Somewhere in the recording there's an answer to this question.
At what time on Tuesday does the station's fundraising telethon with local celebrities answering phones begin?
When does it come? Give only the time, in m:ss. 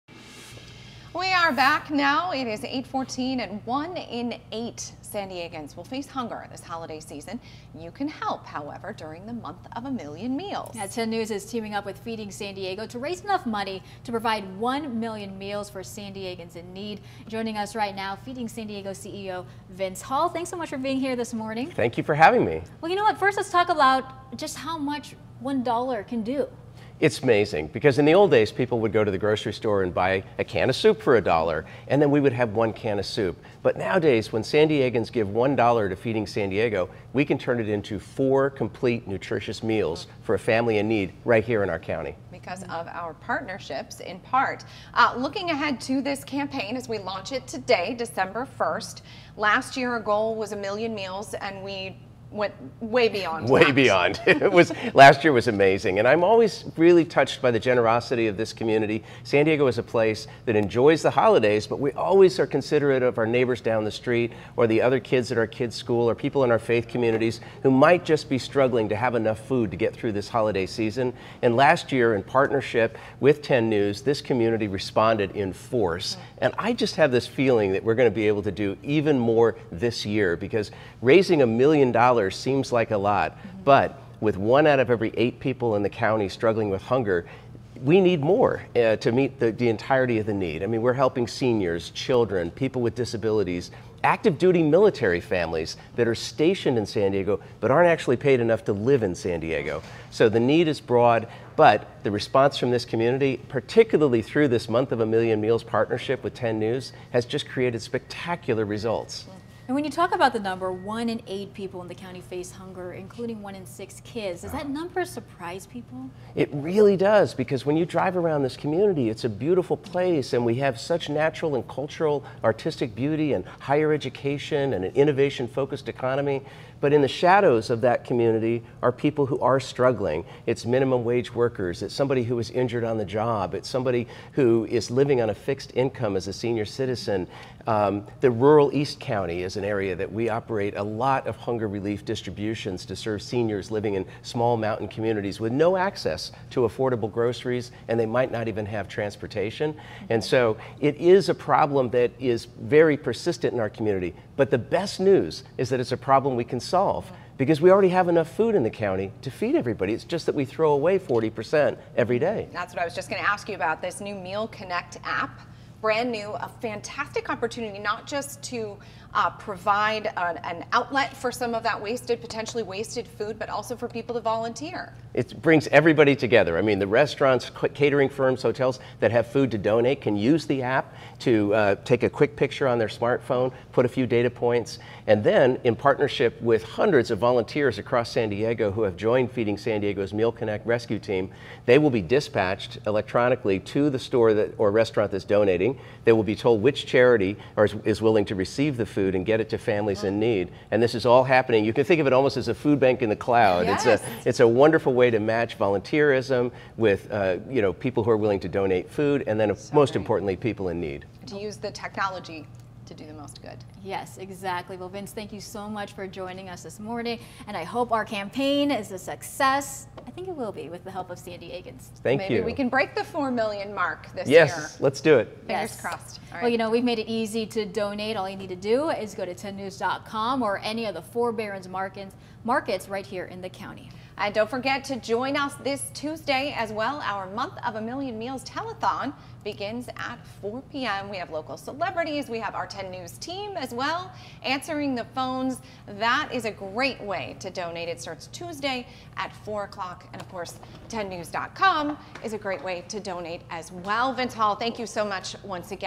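4:00.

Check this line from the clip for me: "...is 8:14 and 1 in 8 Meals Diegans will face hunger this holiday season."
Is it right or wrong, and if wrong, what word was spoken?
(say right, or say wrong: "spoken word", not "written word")
wrong: "San", not "Meals".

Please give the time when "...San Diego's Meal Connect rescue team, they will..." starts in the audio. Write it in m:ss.
3:09.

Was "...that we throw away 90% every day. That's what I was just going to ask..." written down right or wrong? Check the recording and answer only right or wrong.
wrong.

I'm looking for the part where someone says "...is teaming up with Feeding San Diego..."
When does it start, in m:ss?
0:11.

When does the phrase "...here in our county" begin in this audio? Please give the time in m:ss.
0:41.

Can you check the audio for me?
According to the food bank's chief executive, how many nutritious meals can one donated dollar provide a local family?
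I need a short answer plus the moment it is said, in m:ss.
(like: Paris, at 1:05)
4, at 0:37.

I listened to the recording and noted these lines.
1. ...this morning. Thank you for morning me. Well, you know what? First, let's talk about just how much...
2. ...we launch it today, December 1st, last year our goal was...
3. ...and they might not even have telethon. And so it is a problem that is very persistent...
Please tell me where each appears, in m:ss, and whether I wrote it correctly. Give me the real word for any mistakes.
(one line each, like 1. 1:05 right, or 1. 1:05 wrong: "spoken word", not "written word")
1. 0:21 wrong: "having", not "morning"
2. 0:46 right
3. 2:27 wrong: "transportation", not "telethon".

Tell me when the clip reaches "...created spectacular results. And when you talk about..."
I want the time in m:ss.
1:47.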